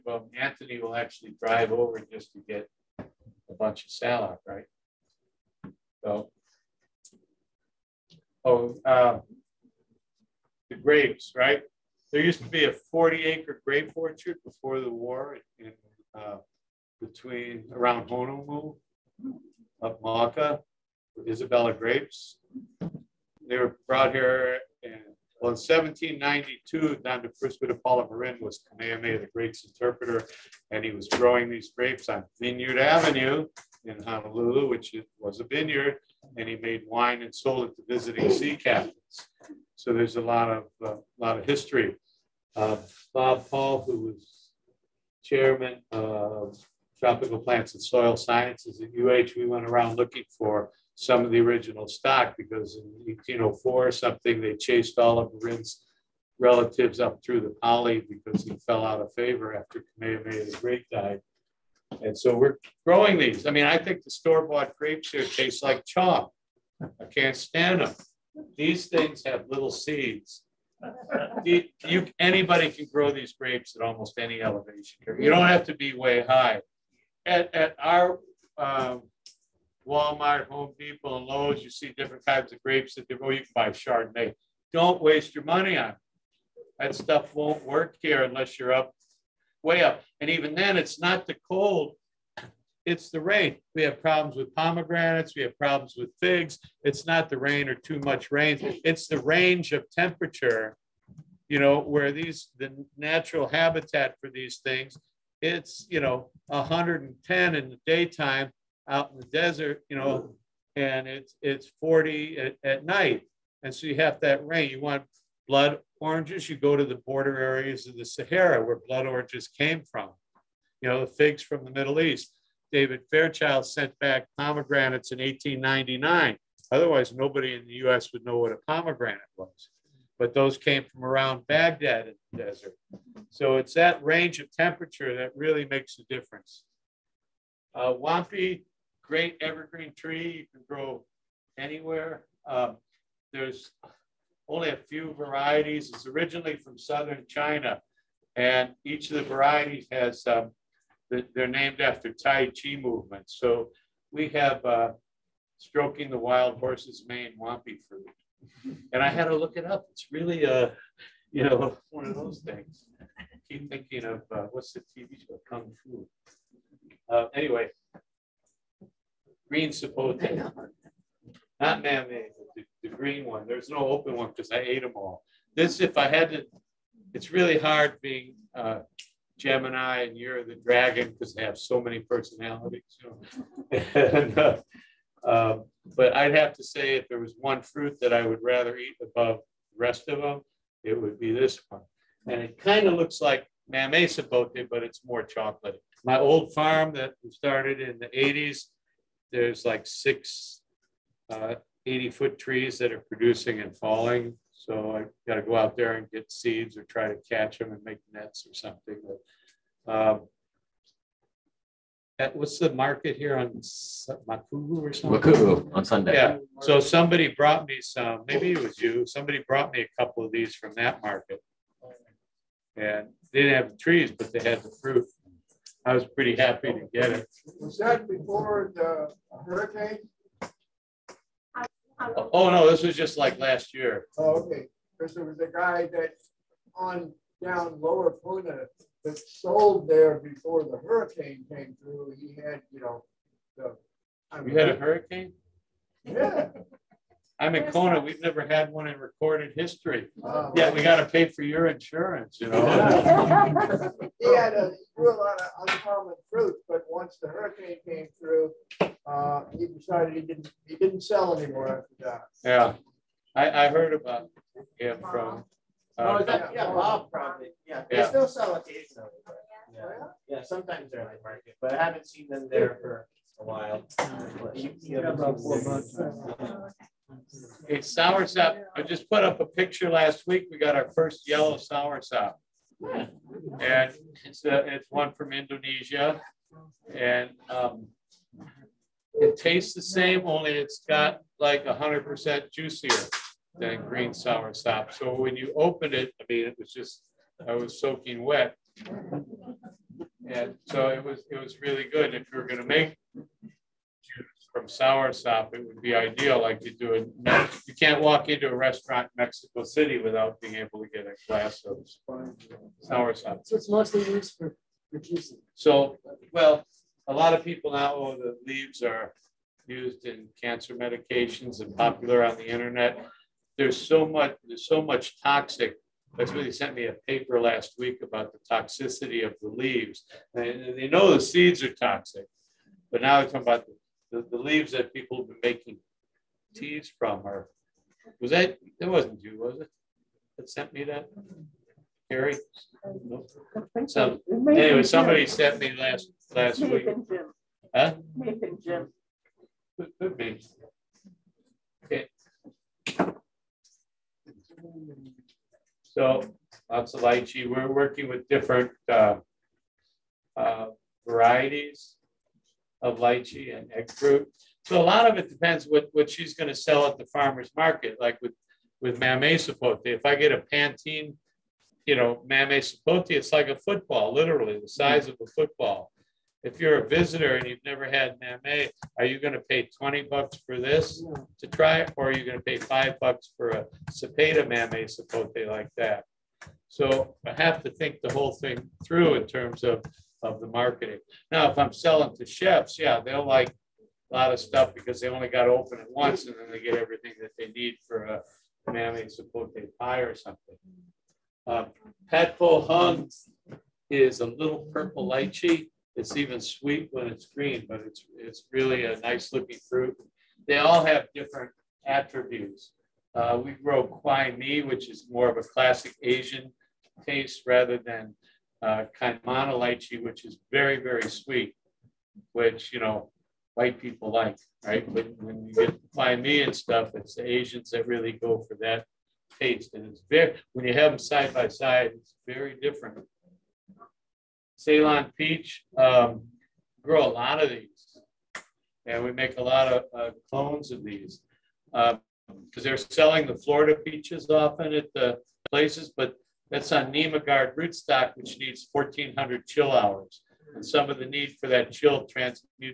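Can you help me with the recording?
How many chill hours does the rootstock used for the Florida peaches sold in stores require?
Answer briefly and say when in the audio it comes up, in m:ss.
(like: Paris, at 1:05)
1,400, at 7:28.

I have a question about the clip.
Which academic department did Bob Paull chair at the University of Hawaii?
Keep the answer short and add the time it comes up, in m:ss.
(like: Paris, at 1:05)
Tropical Plants and Soil Sciences, at 0:46.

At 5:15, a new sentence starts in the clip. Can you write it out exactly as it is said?
So, well, a lot of people now, oh, the leaves are used in cancer medications and popular on the internet.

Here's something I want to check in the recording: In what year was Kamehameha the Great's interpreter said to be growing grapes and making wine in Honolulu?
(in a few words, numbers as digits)
1792.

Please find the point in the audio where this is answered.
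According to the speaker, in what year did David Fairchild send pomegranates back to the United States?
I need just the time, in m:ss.
2:05.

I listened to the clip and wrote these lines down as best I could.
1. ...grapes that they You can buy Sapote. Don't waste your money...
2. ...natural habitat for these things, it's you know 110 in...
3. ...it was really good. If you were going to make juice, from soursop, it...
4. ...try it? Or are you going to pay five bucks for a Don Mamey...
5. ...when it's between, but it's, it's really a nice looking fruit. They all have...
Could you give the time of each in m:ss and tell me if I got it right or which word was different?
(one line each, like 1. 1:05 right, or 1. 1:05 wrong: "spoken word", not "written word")
1. 1:22 wrong: "Chardonnay", not "Sapote"
2. 1:42 right
3. 5:01 right
4. 6:21 wrong: "Cepeda", not "Don"
5. 6:46 wrong: "green", not "between".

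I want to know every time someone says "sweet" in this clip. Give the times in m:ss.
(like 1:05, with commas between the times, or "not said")
6:46, 7:01.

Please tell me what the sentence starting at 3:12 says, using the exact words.
And it kind of looks like Mamey Sapote, but it's more chocolate.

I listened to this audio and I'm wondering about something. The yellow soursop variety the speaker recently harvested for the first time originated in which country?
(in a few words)
Indonesia.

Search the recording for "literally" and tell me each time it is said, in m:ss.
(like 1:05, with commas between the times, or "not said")
6:14.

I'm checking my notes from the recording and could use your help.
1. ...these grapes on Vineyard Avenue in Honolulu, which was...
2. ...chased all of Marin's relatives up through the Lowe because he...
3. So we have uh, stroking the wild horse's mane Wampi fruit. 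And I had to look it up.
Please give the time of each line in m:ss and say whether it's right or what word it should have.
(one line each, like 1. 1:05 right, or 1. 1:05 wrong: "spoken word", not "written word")
1. 0:31 right
2. 0:54 wrong: "Pali", not "Lowe"
3. 2:33 right.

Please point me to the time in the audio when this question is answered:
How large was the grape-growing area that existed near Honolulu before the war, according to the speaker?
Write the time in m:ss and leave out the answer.
0:12.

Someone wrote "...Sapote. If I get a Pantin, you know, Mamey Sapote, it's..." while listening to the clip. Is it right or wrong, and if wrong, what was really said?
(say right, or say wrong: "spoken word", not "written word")
right.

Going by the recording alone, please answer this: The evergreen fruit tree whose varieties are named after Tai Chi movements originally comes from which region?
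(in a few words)
Southern China.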